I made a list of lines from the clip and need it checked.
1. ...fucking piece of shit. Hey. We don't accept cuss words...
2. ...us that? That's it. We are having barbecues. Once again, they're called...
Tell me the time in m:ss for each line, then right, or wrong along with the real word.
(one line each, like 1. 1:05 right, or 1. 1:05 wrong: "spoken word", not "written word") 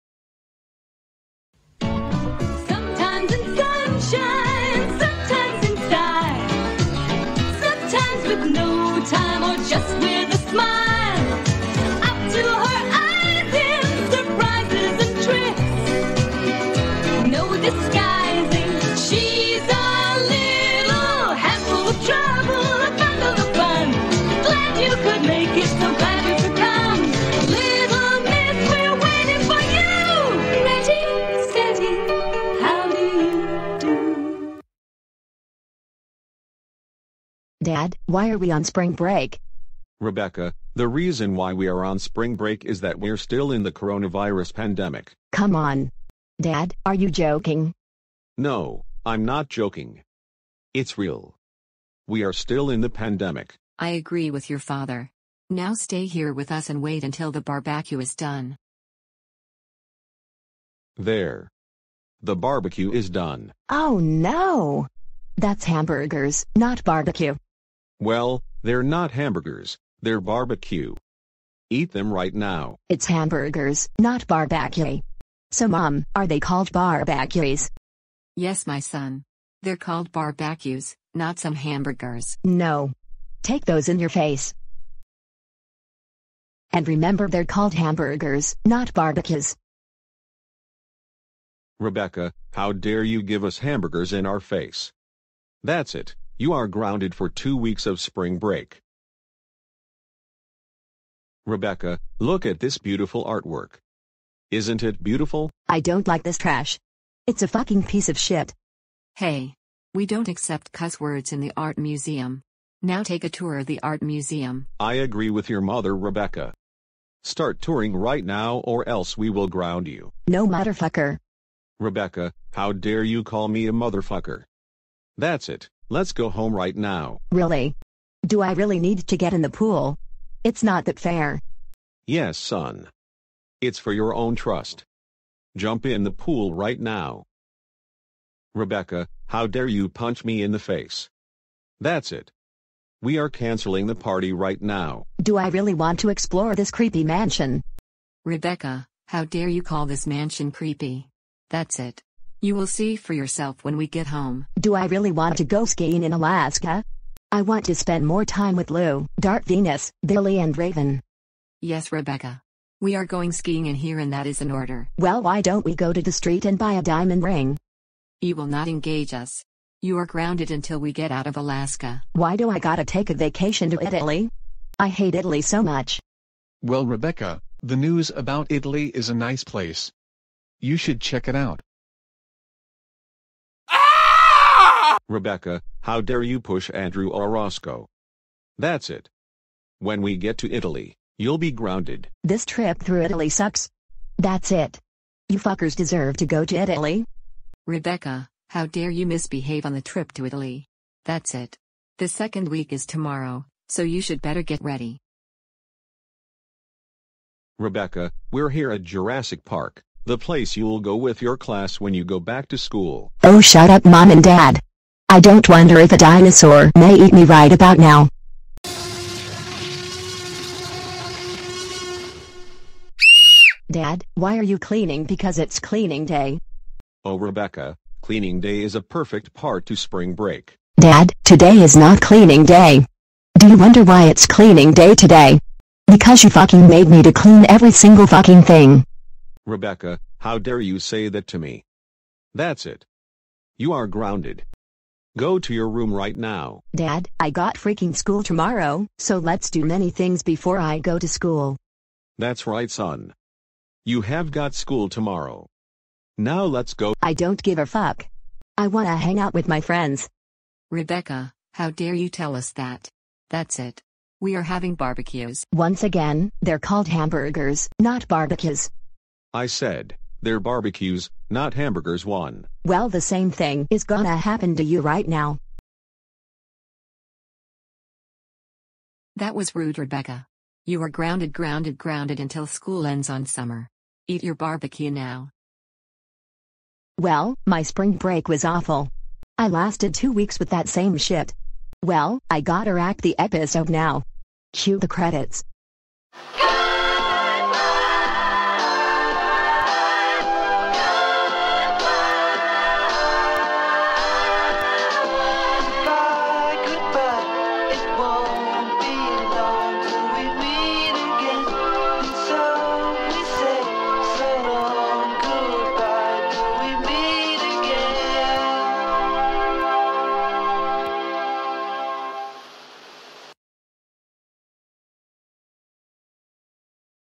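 1. 1:47 right
2. 4:22 right.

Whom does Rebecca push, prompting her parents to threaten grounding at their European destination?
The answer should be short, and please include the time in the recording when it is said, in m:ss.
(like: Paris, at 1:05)
Andrew Roscoe, at 3:06.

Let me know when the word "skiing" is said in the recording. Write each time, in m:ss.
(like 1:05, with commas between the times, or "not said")
2:35, 2:43.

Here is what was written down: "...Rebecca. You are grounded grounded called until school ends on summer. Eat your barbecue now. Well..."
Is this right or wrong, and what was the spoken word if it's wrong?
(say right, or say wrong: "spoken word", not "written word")
wrong: "grounded", not "called".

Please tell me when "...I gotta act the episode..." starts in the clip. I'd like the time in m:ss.
4:52.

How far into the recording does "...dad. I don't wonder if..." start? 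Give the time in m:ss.
3:34.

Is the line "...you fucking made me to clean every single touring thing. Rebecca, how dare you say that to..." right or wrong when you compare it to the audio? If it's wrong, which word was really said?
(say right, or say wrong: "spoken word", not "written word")
wrong: "fucking", not "touring".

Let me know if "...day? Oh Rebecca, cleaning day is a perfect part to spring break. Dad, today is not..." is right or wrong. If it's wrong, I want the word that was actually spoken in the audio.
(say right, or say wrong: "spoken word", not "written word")
right.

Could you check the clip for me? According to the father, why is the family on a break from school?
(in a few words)
coronavirus pandemic.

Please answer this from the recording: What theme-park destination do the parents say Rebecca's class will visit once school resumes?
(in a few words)
Jurassic Park.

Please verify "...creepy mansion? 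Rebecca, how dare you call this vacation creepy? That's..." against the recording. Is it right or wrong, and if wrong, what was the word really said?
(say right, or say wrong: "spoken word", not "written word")
wrong: "mansion", not "vacation".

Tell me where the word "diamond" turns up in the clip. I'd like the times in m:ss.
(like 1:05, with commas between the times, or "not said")
2:46.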